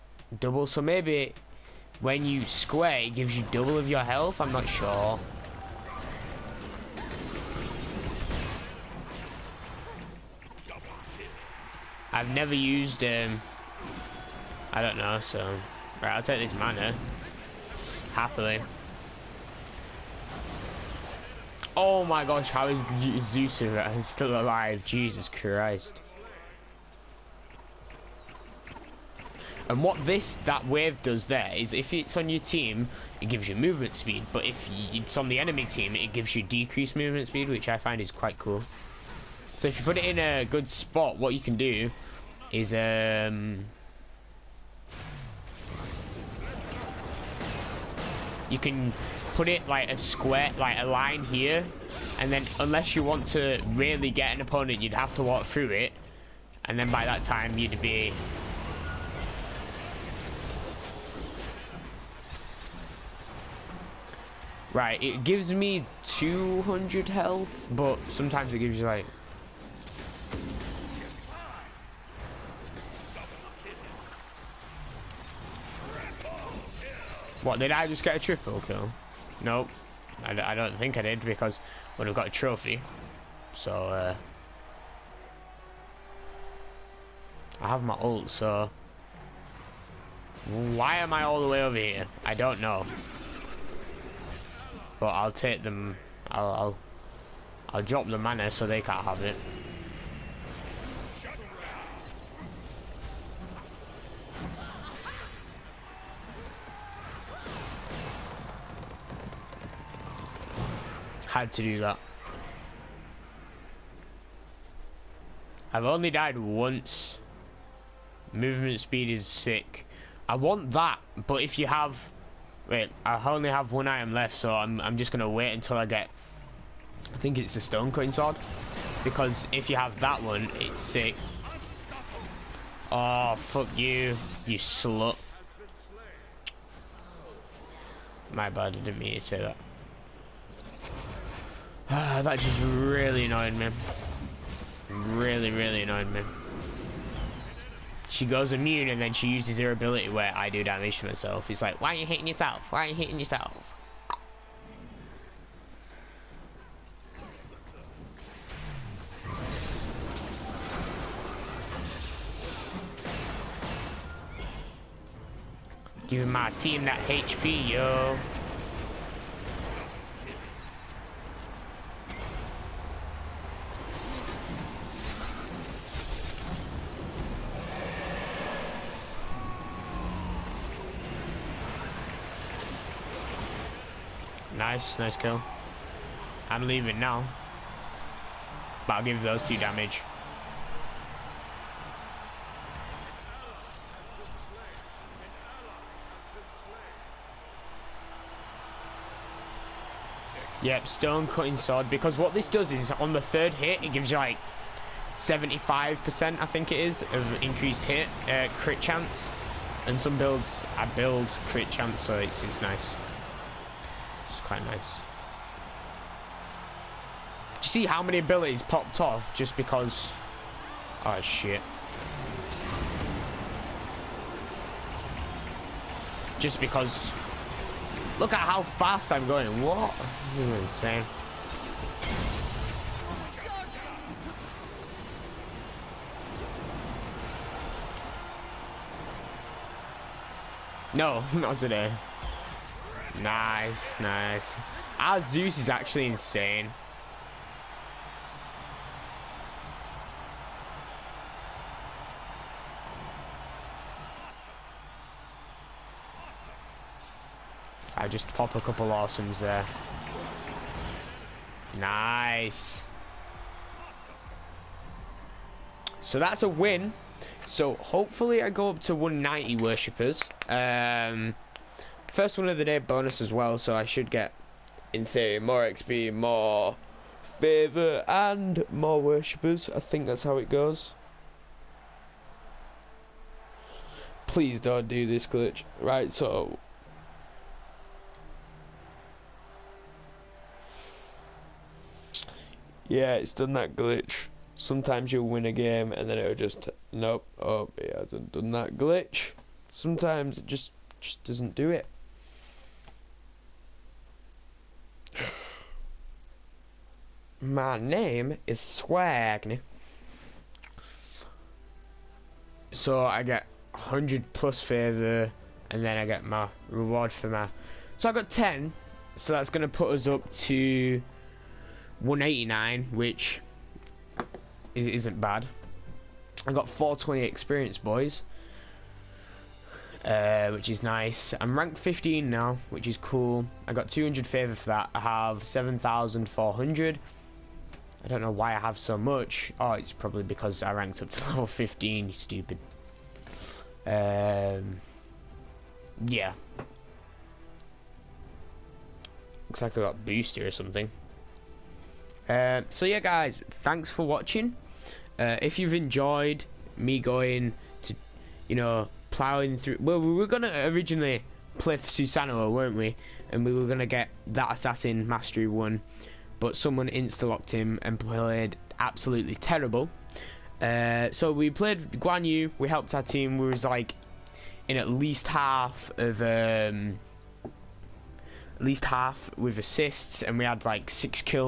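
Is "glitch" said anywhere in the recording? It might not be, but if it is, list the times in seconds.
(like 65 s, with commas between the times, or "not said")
285 s, 293 s, 298 s.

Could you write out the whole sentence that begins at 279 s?
I think that's how it goes.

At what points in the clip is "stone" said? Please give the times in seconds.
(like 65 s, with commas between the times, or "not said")
127 s, 200 s.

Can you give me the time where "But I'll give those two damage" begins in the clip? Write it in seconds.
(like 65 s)
188 s.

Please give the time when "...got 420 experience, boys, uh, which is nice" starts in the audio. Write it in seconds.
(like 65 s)
326 s.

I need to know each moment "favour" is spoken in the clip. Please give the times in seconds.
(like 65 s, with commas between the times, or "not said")
277 s, 314 s, 334 s.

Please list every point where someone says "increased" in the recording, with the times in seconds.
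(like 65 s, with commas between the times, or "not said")
207 s.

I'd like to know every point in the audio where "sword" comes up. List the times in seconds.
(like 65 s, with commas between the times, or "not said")
128 s, 201 s.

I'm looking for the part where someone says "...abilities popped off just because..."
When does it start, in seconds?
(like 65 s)
218 s.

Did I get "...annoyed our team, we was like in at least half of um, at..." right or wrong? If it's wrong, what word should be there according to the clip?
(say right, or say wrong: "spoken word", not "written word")
wrong: "helped", not "annoyed".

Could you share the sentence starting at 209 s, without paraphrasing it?
And some builds, I build crit chance, so it's, it's nice quite nice.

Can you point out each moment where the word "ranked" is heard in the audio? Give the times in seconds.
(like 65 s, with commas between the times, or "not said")
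331 s, 340 s.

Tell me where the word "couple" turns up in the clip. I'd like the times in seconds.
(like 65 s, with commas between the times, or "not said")
258 s.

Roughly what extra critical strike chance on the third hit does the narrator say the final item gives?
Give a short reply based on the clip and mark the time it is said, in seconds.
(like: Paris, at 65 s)
75%, at 205 s.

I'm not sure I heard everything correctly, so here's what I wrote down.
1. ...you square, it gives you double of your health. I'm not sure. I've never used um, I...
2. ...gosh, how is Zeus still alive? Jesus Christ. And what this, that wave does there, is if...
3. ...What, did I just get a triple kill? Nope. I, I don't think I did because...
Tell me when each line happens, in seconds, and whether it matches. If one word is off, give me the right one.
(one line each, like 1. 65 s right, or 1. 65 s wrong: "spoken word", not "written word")
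1. 2 s right
2. 22 s right
3. 77 s right.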